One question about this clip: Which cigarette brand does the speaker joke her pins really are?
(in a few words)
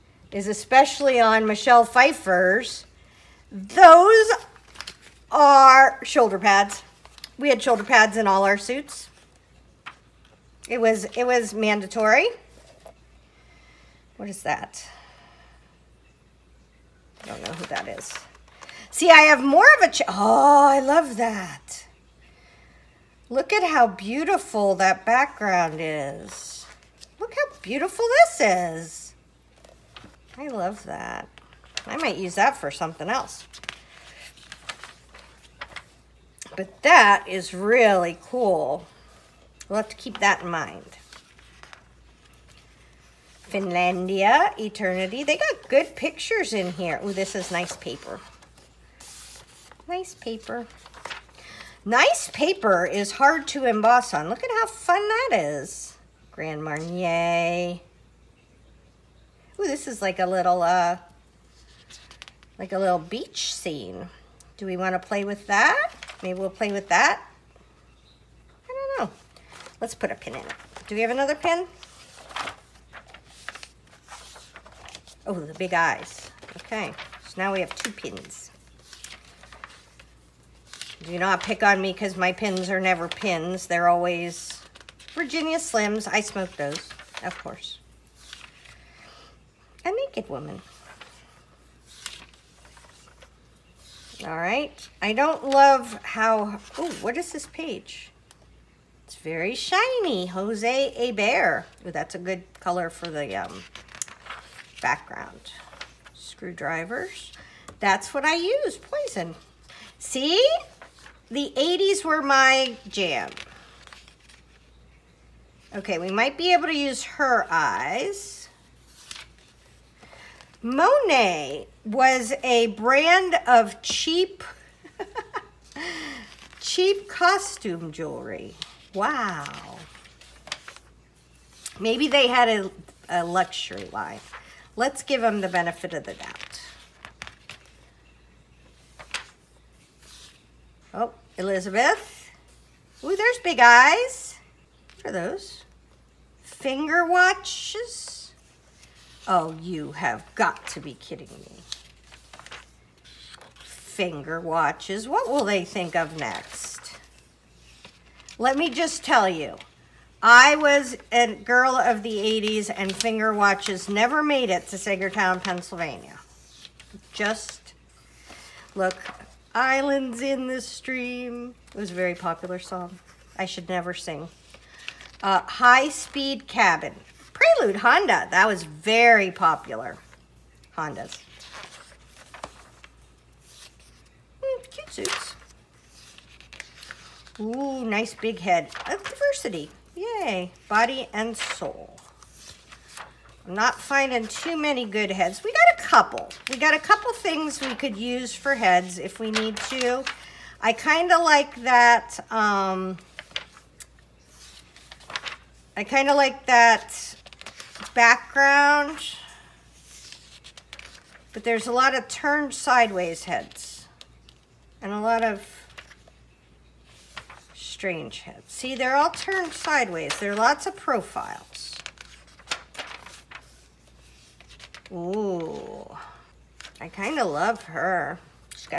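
Virginia Slims.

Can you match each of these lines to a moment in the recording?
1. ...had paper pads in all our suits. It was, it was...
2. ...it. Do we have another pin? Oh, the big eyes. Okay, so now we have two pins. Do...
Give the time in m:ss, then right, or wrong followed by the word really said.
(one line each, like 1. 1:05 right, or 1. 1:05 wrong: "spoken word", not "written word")
1. 0:07 wrong: "shoulder", not "paper"
2. 1:10 right.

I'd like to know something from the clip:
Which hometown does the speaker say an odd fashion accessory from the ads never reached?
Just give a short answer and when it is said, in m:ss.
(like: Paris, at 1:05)
Saegertown, Pennsylvania, at 2:44.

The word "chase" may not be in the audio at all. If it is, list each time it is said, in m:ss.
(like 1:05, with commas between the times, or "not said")
not said.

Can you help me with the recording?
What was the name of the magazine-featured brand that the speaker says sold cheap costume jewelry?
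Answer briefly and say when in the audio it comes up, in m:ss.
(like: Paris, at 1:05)
Monet, at 2:00.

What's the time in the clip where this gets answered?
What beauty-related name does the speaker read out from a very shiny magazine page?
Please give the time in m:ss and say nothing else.
1:40.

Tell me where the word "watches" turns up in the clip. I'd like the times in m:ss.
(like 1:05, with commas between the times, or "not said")
2:27, 2:34, 2:43.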